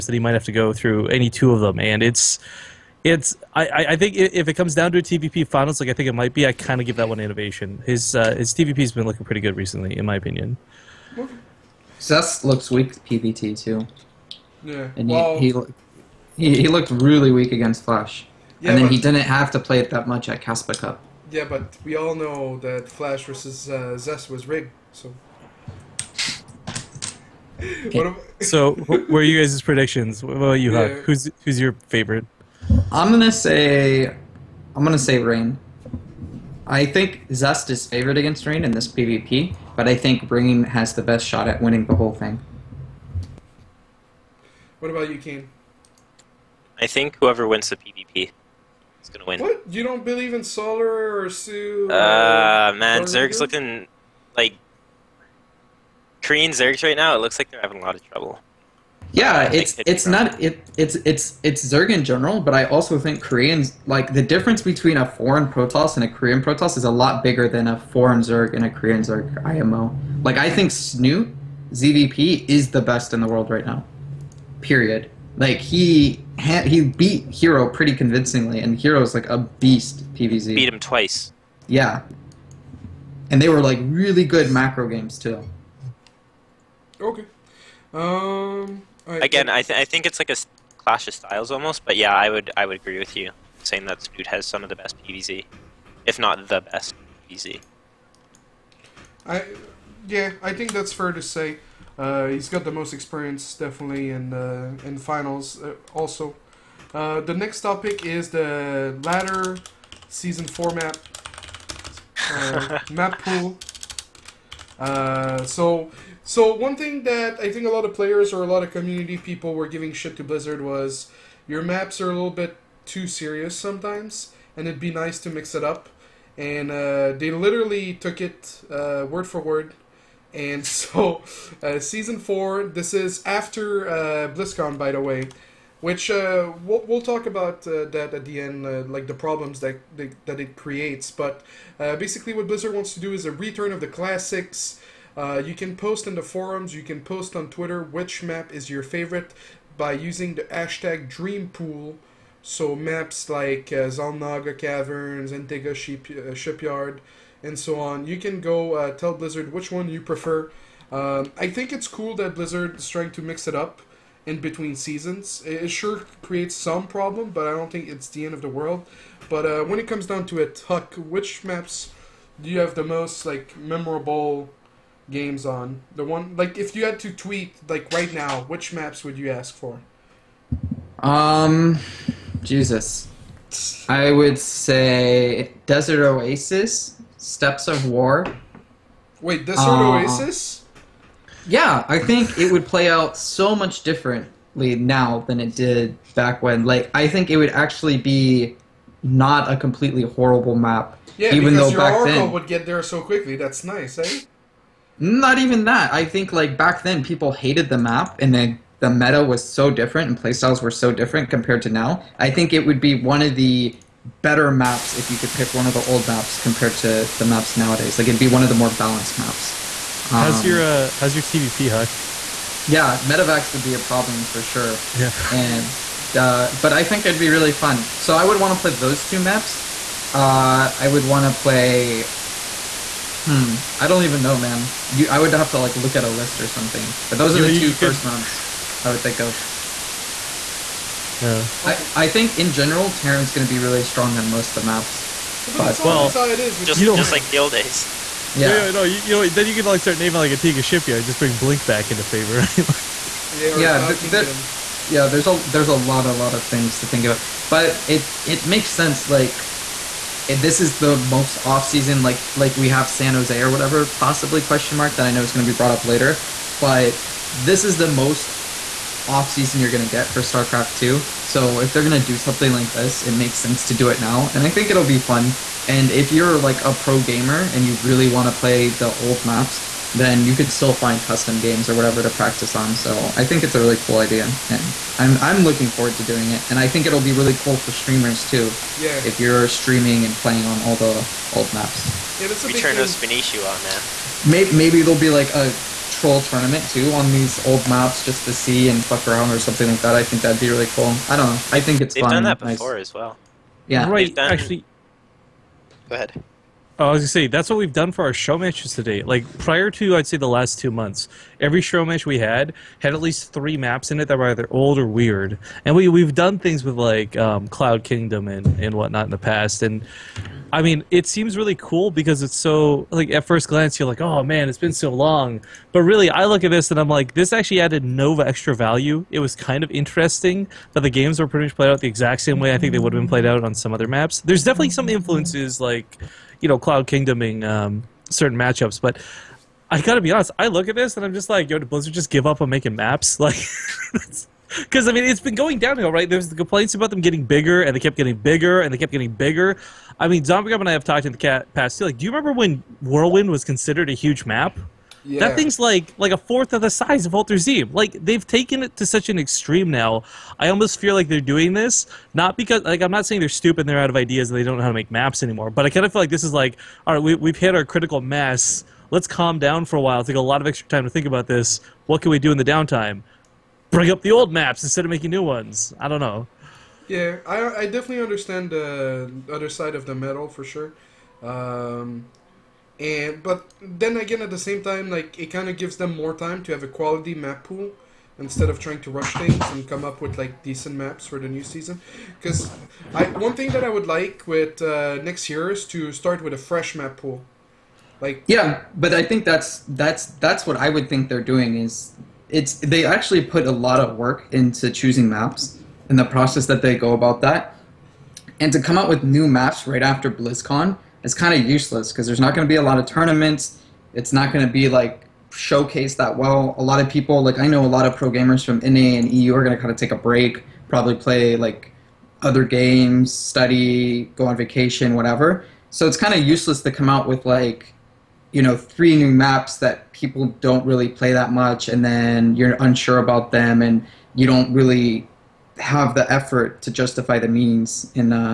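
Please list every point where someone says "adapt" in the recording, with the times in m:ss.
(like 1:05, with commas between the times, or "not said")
not said.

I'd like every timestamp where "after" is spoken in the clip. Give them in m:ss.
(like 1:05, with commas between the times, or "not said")
2:13, 6:49.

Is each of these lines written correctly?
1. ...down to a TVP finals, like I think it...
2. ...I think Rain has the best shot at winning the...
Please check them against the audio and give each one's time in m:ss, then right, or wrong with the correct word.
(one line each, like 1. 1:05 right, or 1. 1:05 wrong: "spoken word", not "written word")
1. 0:04 right
2. 0:39 right.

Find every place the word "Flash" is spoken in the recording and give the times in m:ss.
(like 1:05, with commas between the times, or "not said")
0:17, 0:22.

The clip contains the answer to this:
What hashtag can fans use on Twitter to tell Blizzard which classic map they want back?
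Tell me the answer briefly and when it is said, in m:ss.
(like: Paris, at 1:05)
DreamPool, at 2:31.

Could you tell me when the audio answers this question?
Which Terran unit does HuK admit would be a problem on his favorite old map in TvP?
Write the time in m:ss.
3:42.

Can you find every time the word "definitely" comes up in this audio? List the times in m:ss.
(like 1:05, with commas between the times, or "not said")
1:43, 5:34, 6:17.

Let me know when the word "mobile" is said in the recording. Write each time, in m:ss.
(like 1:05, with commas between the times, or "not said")
not said.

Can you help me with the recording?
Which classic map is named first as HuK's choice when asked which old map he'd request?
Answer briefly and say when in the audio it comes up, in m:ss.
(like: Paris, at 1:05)
Desert Oasis, at 3:05.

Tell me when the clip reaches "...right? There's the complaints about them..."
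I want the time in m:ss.
5:45.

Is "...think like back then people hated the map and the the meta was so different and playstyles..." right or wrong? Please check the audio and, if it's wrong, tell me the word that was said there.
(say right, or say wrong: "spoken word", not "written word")
right.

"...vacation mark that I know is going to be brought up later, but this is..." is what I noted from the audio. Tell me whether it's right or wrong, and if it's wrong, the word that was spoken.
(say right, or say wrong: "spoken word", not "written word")
wrong: "question", not "vacation".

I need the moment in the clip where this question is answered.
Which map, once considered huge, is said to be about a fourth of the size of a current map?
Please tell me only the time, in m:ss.
5:52.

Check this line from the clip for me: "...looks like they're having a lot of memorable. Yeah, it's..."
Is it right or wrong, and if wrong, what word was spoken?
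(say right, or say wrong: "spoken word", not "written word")
wrong: "trouble", not "memorable".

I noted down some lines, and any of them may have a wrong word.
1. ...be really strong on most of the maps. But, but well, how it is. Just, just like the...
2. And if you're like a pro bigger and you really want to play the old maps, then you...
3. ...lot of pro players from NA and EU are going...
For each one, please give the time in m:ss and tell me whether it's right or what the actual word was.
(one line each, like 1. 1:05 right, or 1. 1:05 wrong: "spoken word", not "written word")
1. 4:03 right
2. 4:35 wrong: "gamer", not "bigger"
3. 6:57 wrong: "gamers", not "players".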